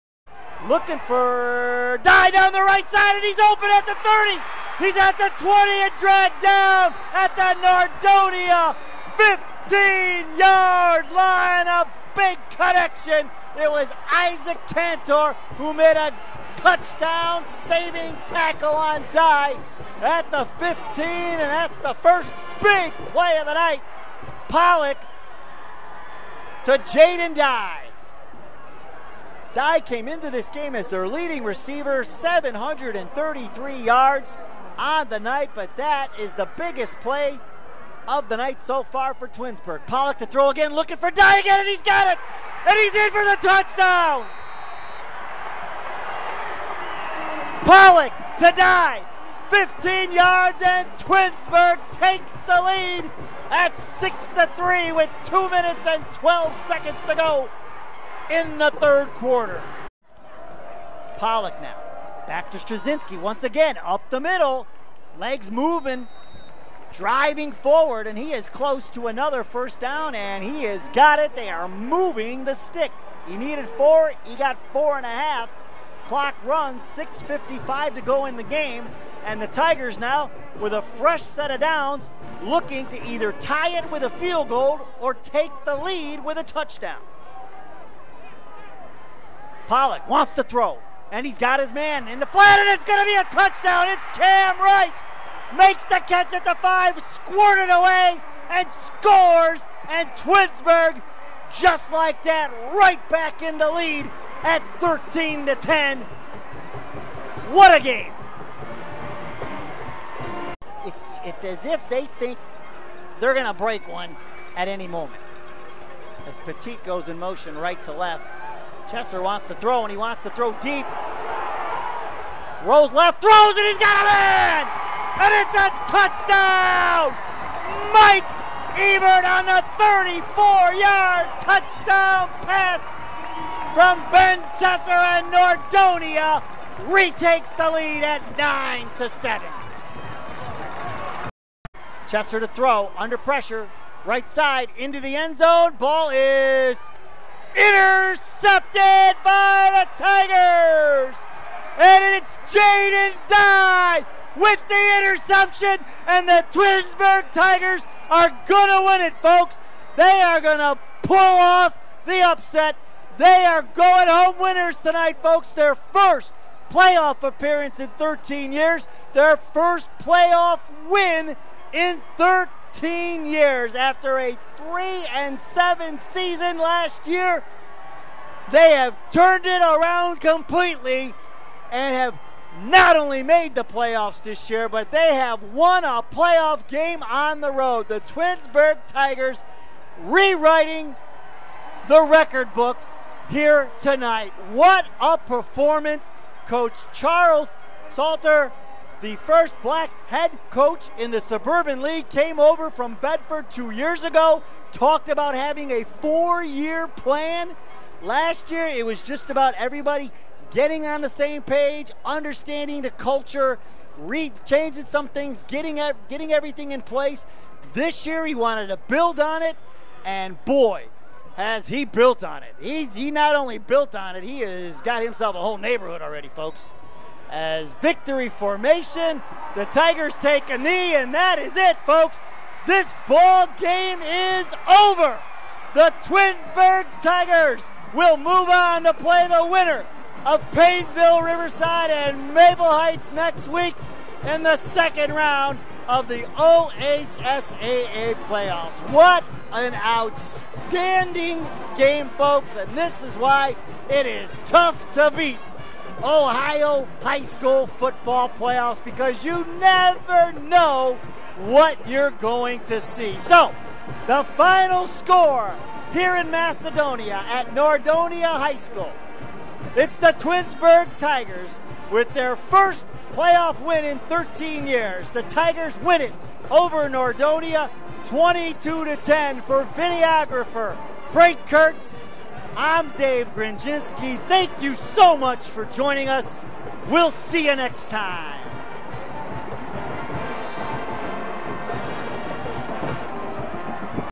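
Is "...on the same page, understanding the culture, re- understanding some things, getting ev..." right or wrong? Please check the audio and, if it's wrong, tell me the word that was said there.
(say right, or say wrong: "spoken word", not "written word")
wrong: "changing", not "understanding".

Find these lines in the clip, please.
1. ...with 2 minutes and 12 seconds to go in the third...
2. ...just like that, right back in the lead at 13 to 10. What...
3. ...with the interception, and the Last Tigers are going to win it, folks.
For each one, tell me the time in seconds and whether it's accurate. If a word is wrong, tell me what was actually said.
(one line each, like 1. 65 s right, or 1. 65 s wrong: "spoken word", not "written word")
1. 54 s right
2. 101 s right
3. 154 s wrong: "Twinsburg", not "Last".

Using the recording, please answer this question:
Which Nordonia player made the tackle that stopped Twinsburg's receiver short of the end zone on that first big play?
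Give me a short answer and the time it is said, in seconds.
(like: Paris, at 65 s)
Isaac Cantor, at 14 s.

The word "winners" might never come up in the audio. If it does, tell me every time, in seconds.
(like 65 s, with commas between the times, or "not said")
164 s, 239 s.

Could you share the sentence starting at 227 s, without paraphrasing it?
As victory formation, the Tigers take a knee, and that is it, folks.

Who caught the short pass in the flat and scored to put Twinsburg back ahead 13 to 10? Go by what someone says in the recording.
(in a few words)
Cam Wright.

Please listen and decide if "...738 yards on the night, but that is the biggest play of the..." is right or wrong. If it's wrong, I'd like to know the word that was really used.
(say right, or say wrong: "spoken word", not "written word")
wrong: "733", not "738".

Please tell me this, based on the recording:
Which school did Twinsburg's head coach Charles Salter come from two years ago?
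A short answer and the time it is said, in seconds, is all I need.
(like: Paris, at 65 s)
Bedford, at 202 s.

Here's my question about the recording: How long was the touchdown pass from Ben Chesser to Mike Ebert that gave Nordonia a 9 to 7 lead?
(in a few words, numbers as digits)
34 yards.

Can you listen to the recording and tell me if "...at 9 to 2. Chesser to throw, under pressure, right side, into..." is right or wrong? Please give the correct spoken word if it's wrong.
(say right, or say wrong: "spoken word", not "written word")
wrong: "7", not "2".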